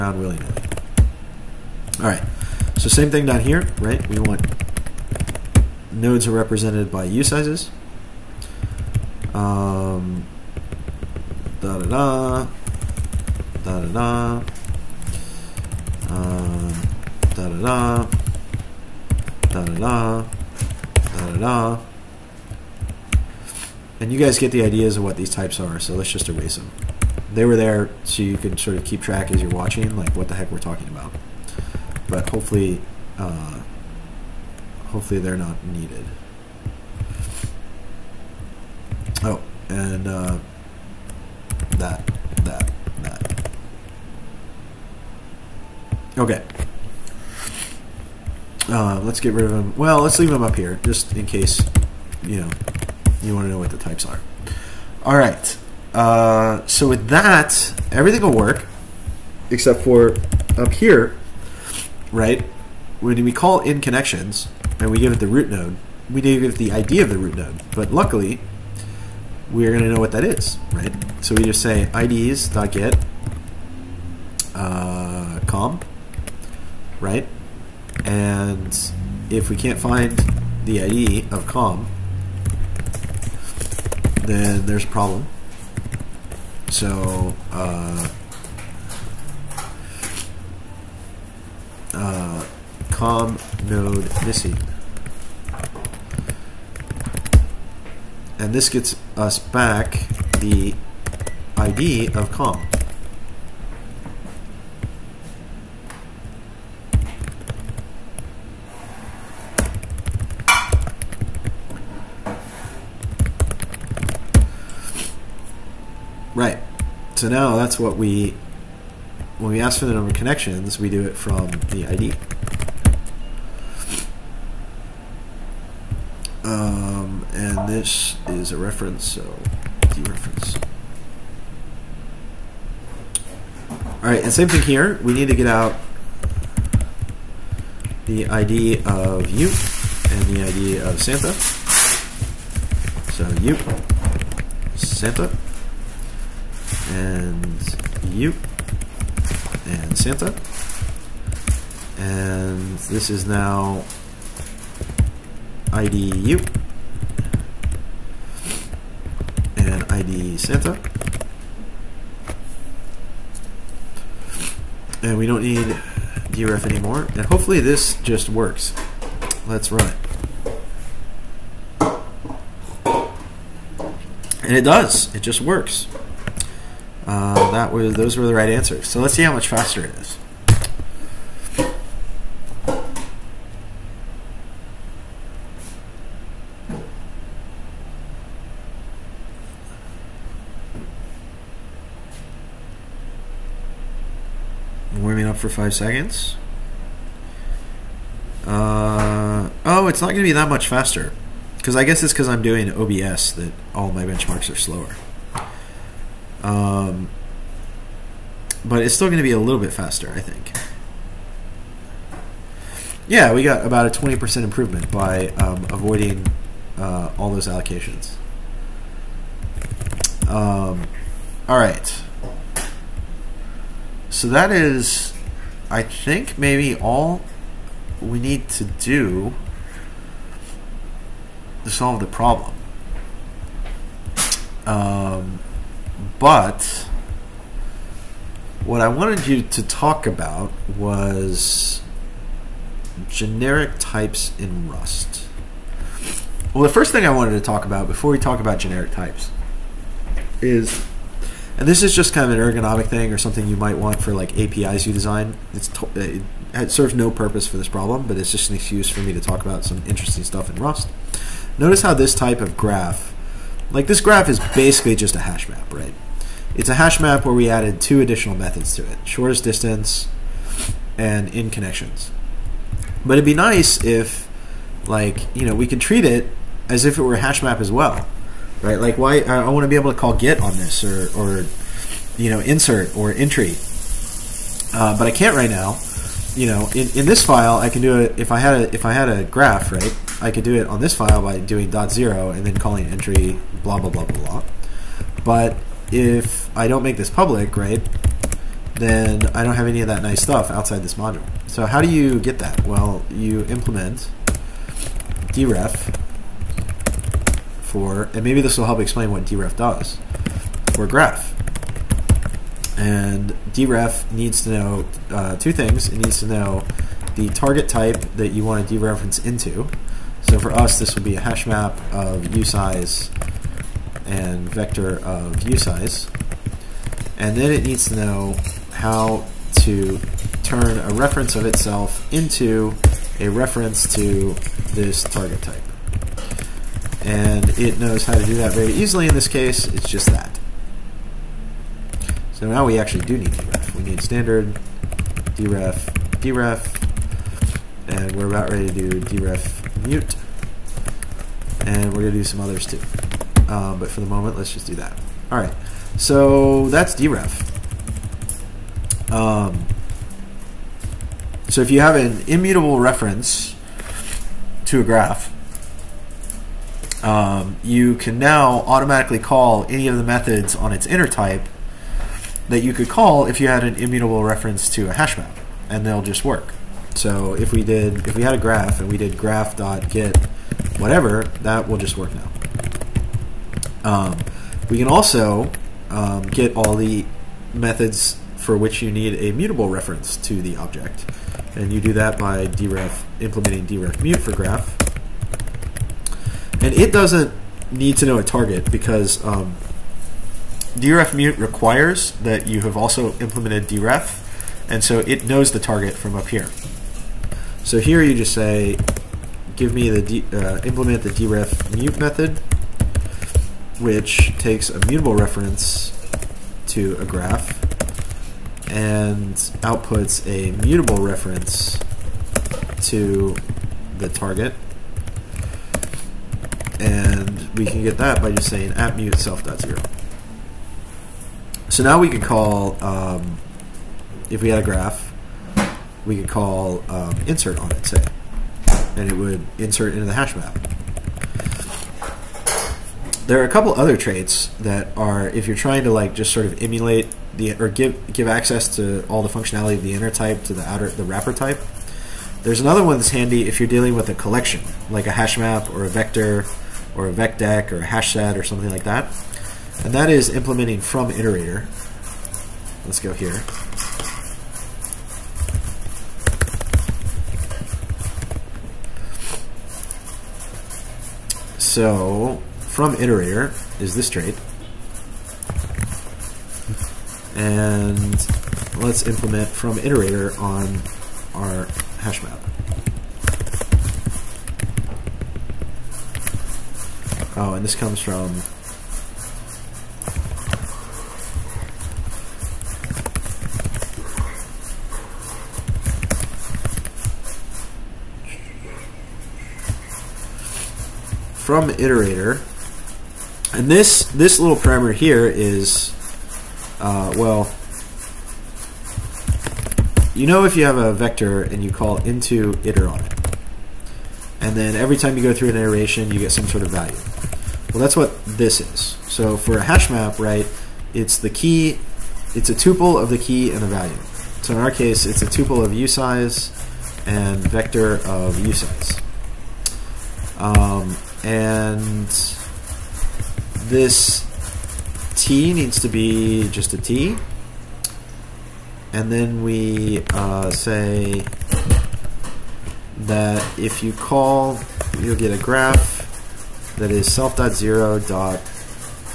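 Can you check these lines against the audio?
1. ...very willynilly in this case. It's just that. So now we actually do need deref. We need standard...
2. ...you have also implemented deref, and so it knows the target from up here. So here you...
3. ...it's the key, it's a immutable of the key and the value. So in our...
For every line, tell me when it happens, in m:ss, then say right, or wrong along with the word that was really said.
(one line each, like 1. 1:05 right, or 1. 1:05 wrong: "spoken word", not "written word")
1. 5:38 wrong: "easily", not "willynilly"
2. 6:42 right
3. 8:40 wrong: "tuple", not "immutable".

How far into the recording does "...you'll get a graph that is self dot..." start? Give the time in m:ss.
9:04.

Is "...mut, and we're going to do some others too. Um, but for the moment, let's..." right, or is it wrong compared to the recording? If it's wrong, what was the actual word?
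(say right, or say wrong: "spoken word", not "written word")
right.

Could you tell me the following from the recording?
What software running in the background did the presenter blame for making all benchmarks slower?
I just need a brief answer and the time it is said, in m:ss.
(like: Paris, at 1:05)
OBS, at 3:22.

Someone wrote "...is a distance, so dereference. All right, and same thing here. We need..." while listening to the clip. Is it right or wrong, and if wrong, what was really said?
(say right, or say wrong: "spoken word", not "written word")
wrong: "reference", not "distance".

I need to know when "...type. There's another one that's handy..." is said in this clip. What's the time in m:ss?
7:31.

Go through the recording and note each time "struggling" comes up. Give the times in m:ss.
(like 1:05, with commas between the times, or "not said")
not said.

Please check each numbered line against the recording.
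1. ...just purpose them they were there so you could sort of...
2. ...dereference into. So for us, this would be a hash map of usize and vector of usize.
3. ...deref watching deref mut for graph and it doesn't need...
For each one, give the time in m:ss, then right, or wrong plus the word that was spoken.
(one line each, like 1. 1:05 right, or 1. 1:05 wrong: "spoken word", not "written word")
1. 0:26 wrong: "erase", not "purpose"
2. 5:18 right
3. 6:32 wrong: "implementing", not "watching".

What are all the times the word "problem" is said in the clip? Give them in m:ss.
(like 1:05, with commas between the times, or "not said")
1:24, 3:52, 4:17.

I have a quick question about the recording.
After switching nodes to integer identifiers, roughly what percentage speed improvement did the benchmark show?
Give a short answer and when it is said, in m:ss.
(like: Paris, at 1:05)
20%, at 3:33.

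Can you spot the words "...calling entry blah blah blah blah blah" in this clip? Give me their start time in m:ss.
4:52.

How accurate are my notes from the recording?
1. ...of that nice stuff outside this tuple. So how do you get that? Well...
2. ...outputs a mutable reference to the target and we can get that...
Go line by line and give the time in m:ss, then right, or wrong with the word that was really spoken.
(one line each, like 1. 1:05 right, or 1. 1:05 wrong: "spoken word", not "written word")
1. 4:59 wrong: "module", not "tuple"
2. 6:59 right.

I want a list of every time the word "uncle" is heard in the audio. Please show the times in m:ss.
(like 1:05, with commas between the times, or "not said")
not said.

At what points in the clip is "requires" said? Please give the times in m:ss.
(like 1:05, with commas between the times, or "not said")
6:41.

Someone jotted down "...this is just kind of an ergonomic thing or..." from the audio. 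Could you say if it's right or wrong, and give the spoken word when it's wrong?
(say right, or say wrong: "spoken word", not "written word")
right.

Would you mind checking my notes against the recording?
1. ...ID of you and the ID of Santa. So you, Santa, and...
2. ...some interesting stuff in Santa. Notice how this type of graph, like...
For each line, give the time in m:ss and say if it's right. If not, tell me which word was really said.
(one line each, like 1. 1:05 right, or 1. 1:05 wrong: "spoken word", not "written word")
1. 2:18 right
2. 4:19 wrong: "Rust", not "Santa".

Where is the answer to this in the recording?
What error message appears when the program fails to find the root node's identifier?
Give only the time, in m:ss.
1:32.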